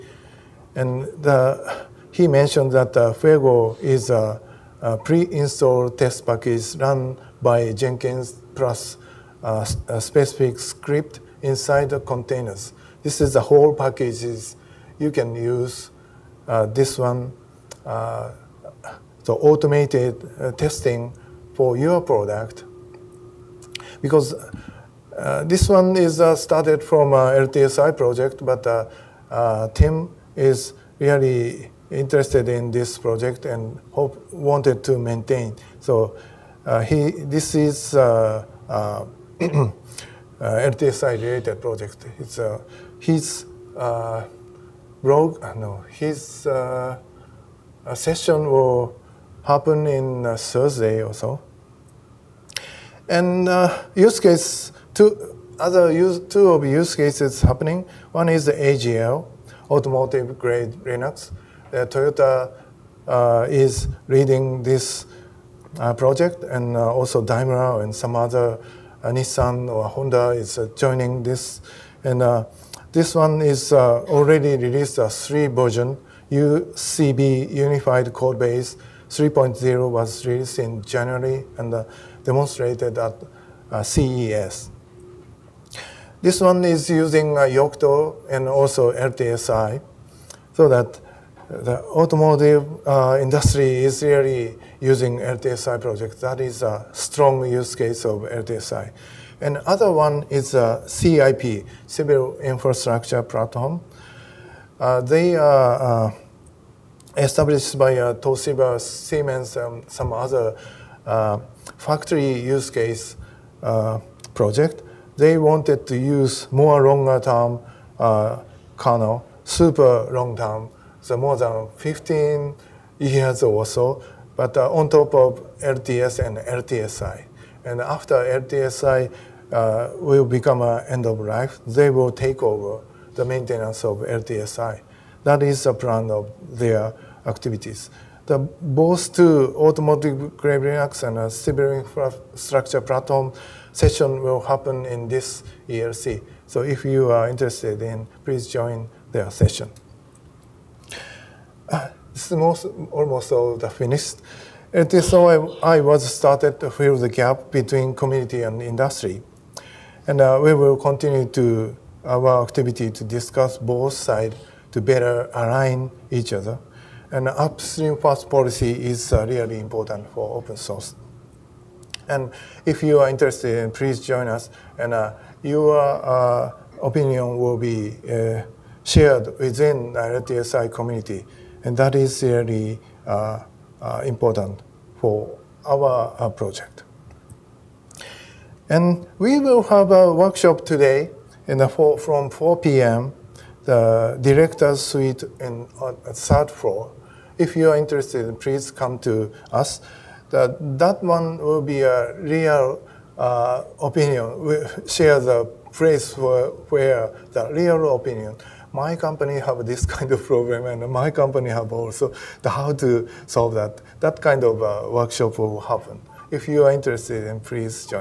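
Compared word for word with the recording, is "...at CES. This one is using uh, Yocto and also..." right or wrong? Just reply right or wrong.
right.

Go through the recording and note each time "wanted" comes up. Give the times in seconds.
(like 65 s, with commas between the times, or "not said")
34 s, 115 s.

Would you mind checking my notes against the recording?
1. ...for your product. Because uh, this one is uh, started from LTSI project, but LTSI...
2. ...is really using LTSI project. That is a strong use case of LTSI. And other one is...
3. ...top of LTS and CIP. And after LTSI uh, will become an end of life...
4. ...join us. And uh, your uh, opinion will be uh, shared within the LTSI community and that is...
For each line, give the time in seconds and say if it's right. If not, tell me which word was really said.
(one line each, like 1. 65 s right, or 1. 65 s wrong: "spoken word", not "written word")
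1. 21 s wrong: "Tim", not "LTSI"
2. 93 s right
3. 124 s wrong: "LTSI", not "CIP"
4. 173 s right.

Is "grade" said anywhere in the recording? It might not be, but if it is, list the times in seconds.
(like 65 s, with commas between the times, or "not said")
60 s, 140 s.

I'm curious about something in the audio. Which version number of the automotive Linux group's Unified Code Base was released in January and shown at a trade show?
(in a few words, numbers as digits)
3.0.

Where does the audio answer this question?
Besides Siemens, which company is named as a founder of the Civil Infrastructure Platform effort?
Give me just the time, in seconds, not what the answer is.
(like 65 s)
108 s.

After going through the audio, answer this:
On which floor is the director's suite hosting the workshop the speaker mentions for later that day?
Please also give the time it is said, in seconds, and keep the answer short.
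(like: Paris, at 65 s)
third floor, at 196 s.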